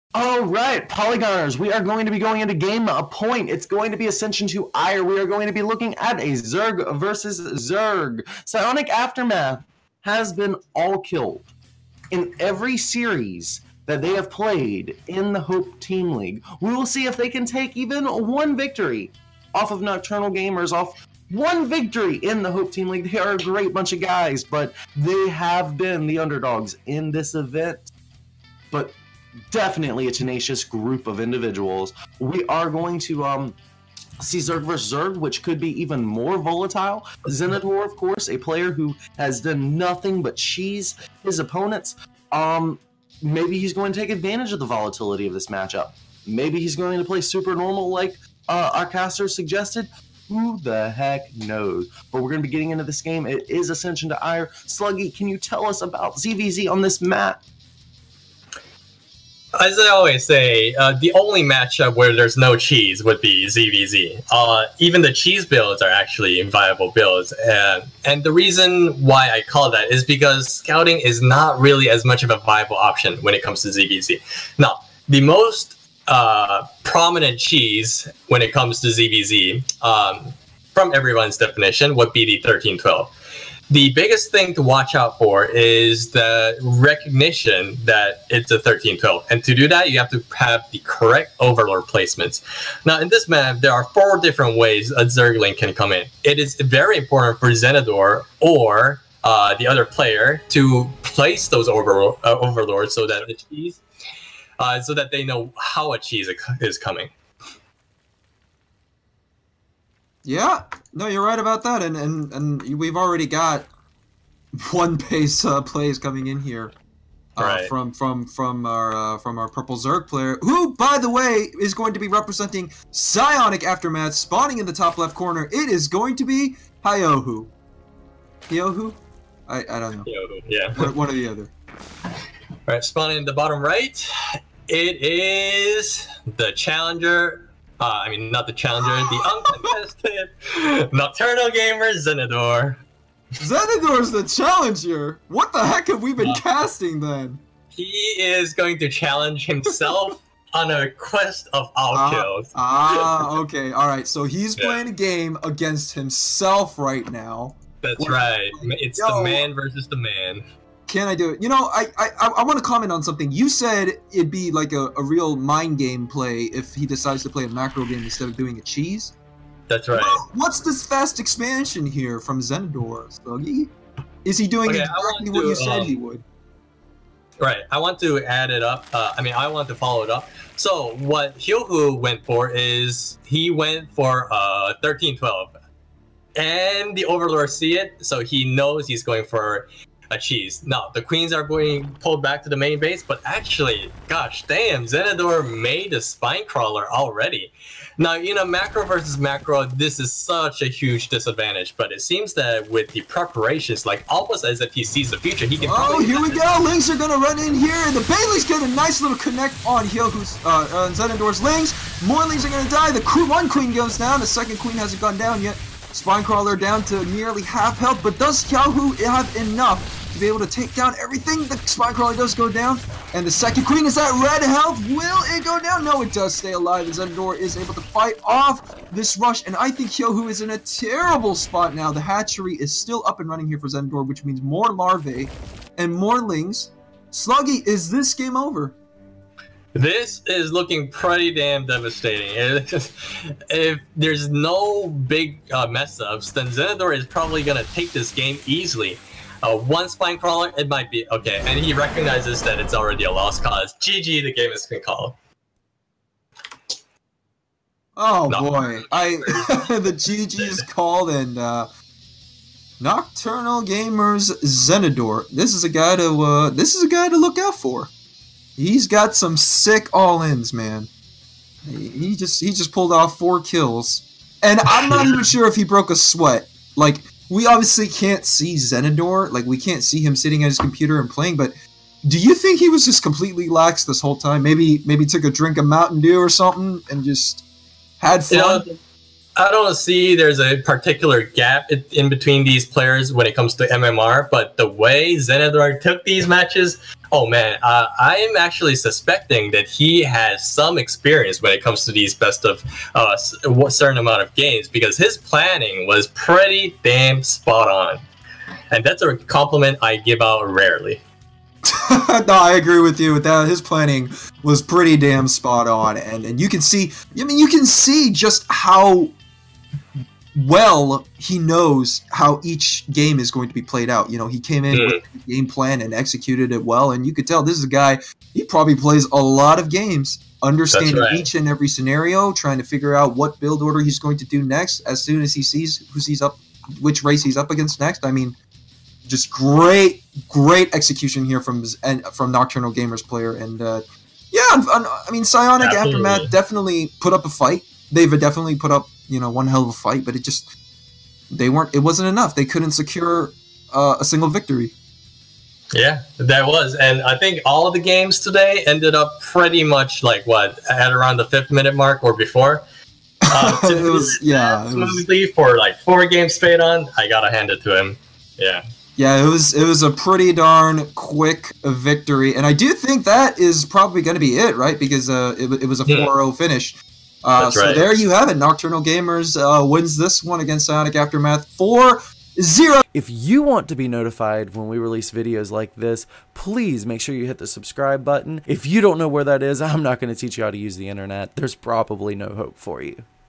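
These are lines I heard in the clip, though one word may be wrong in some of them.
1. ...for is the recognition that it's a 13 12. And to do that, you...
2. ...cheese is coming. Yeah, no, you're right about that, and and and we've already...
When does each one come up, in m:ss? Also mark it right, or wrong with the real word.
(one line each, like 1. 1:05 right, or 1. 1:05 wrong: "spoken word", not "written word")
1. 1:25 right
2. 1:45 right.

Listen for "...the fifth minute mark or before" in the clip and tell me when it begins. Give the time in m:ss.
6:01.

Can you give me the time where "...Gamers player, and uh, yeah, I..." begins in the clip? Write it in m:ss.
5:42.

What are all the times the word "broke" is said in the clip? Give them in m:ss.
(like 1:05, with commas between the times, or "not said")
4:35.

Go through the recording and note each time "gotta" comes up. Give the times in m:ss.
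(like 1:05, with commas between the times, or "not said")
6:07.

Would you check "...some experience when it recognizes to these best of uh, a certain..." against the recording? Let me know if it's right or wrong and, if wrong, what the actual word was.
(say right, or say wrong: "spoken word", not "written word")
wrong: "comes", not "recognizes".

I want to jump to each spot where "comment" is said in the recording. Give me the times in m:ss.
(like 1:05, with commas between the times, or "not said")
2:42.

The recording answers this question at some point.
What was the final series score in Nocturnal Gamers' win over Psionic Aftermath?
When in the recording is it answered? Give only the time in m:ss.
6:20.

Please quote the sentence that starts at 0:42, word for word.
Um, maybe he's going to take advantage of the volatility of this matchup.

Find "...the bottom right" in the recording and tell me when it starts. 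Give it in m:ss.
2:13.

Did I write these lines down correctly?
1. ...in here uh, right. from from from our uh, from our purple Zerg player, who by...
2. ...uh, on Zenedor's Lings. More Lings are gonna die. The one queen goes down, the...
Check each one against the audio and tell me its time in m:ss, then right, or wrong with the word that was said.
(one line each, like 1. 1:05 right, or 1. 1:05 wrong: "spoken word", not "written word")
1. 1:56 right
2. 3:30 right.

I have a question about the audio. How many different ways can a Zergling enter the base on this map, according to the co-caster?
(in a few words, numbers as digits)
4.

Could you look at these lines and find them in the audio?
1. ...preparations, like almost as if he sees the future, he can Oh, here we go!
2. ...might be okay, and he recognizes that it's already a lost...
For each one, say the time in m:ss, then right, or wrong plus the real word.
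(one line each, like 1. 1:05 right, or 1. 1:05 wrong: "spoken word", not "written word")
1. 3:23 right
2. 4:10 right.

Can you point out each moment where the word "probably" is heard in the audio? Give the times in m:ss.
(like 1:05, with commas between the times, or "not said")
4:07, 5:28, 6:13, 6:31.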